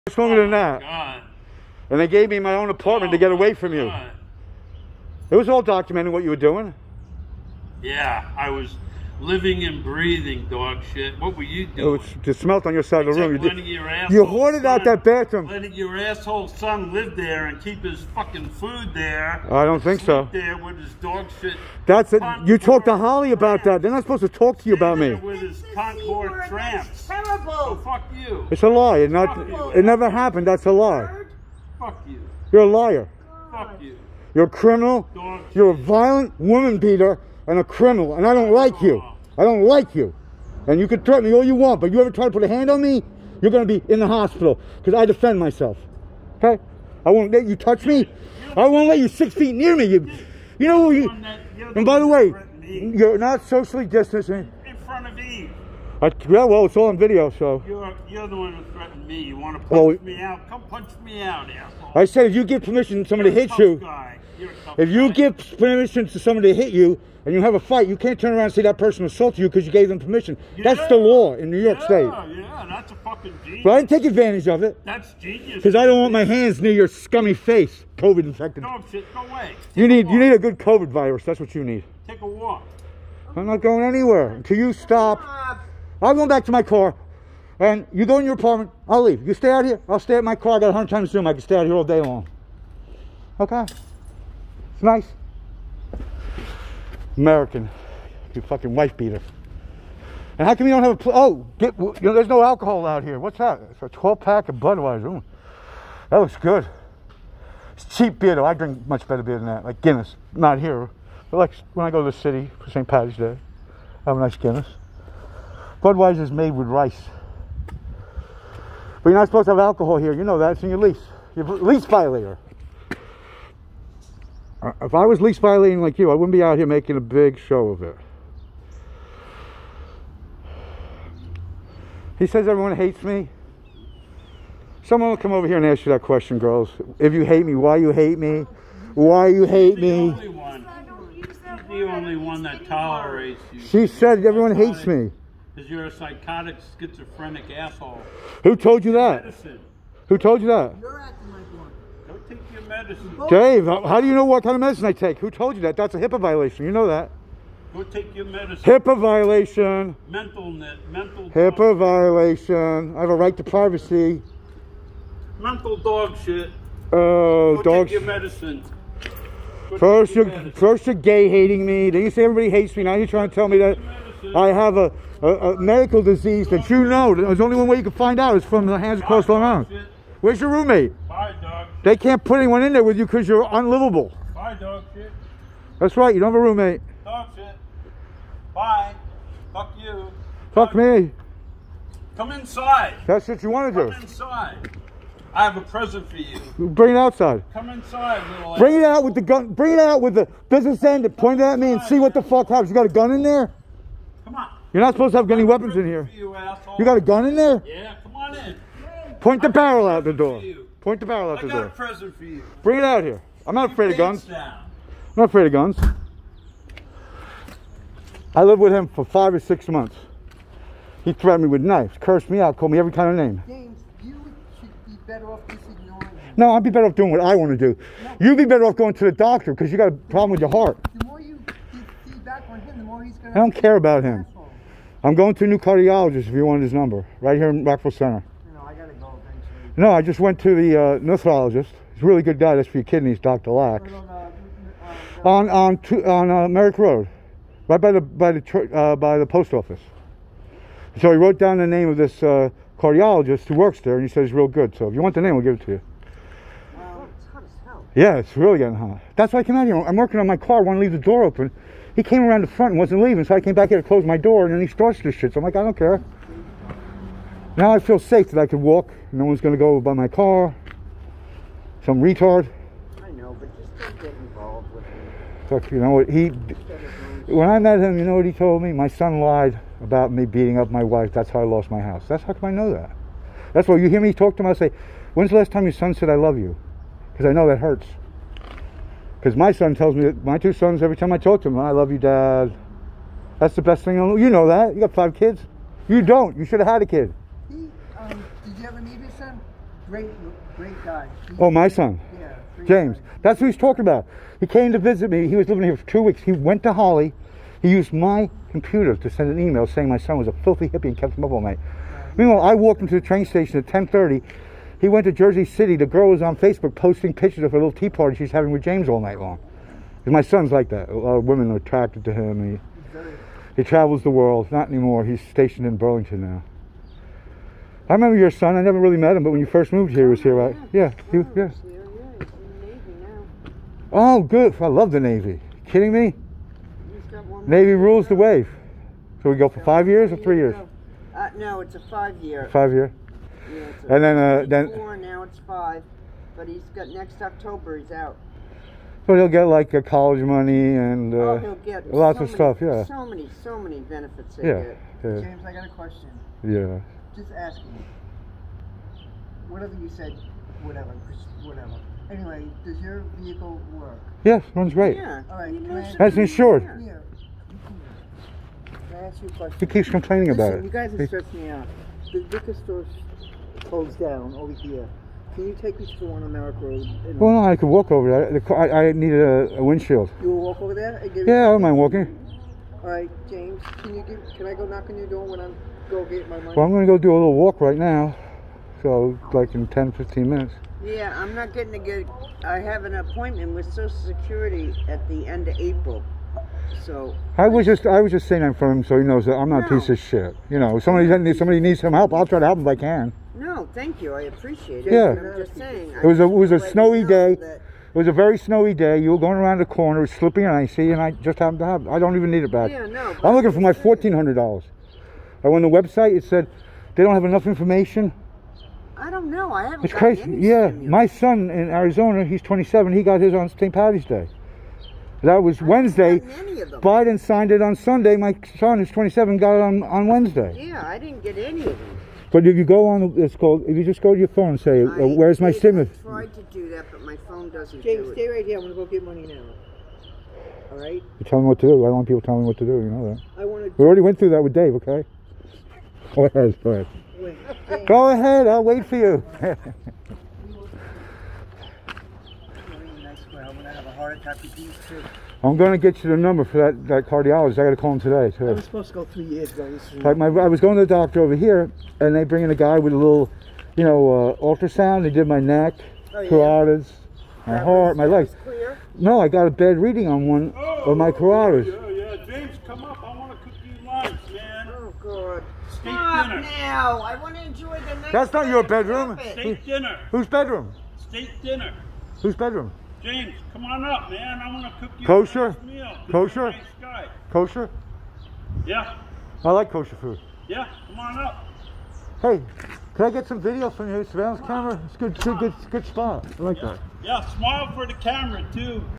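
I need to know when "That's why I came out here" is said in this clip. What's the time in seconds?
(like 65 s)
259 s.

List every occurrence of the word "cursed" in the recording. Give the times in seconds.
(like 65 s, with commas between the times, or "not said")
221 s.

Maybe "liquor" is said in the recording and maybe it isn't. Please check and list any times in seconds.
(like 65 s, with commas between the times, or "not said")
372 s.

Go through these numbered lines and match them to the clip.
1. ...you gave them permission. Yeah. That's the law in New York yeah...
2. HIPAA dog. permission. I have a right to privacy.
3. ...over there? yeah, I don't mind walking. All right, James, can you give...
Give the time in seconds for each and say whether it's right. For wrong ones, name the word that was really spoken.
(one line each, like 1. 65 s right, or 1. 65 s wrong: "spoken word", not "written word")
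1. 69 s right
2. 161 s wrong: "violation", not "permission"
3. 380 s right.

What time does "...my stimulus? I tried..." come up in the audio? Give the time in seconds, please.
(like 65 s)
435 s.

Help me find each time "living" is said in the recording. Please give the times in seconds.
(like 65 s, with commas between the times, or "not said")
9 s, 305 s.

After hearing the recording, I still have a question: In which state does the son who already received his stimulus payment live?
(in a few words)
Arizona.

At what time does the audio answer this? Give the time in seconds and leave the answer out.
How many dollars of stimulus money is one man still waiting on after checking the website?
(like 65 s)
413 s.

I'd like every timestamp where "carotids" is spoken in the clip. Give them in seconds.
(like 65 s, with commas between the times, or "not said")
466 s, 471 s.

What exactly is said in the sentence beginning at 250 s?
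So he wrote down the name of this uh, cardiologist who works there, and he says he's real good.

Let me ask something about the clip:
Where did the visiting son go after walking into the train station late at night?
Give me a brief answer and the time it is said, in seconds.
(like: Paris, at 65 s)
Jersey City, at 315 s.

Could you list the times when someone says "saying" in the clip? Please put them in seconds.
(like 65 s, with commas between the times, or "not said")
309 s, 398 s, 405 s.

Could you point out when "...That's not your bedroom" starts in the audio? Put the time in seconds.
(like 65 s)
478 s.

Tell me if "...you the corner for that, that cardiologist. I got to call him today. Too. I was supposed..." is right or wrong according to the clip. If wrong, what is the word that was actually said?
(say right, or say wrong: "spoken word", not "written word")
wrong: "number", not "corner".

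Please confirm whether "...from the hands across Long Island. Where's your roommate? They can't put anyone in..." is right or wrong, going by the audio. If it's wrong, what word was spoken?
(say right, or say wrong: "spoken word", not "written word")
right.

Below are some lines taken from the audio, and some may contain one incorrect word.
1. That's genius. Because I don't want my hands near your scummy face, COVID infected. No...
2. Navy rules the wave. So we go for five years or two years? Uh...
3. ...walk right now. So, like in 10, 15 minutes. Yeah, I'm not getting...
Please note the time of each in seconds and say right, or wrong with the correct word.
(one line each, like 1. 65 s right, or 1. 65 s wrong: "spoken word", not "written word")
1. 74 s right
2. 337 s wrong: "three", not "two"
3. 387 s right.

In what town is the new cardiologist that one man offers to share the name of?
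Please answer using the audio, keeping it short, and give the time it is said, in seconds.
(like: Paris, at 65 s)
Rockville Center, at 237 s.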